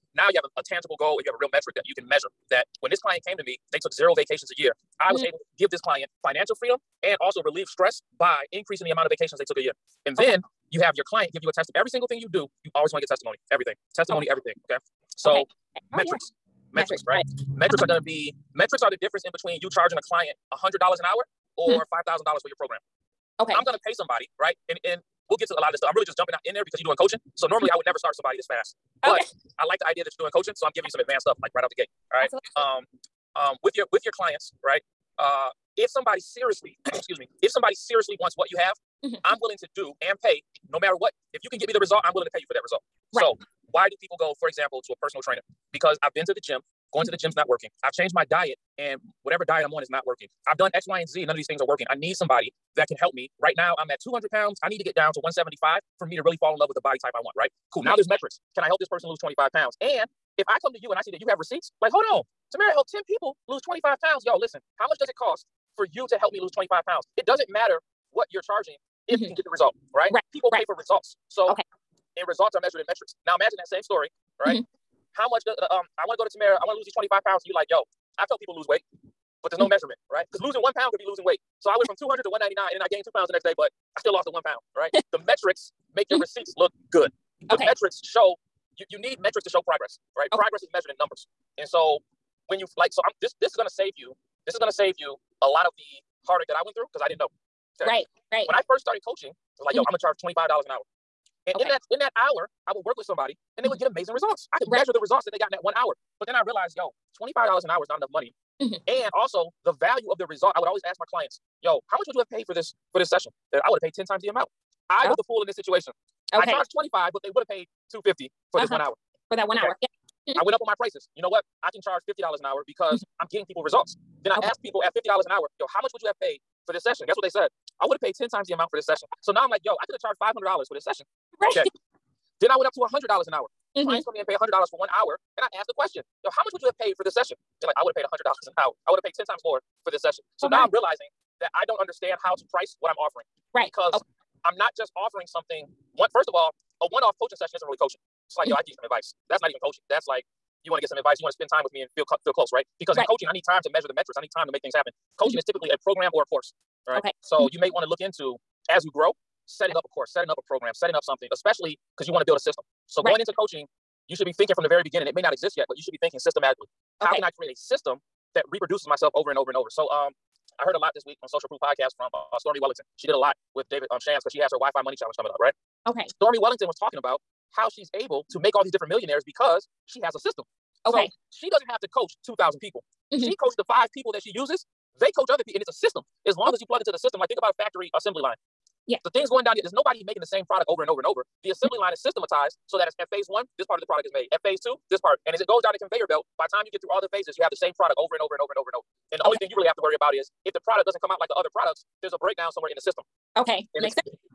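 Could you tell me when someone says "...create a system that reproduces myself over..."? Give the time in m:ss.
2:47.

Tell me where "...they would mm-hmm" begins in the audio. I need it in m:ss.
1:43.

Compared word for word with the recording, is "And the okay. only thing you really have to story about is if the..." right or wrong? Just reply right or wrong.
wrong.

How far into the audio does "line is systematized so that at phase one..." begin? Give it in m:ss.
3:11.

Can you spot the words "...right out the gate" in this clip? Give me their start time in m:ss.
0:31.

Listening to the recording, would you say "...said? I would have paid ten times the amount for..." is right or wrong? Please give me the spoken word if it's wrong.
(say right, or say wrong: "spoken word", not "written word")
right.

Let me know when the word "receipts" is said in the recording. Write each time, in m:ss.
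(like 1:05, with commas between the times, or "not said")
1:01, 1:26.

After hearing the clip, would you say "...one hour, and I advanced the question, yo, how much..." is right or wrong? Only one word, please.
wrong.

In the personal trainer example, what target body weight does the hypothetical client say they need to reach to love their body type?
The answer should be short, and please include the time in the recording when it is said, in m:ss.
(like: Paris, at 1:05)
175, at 0:55.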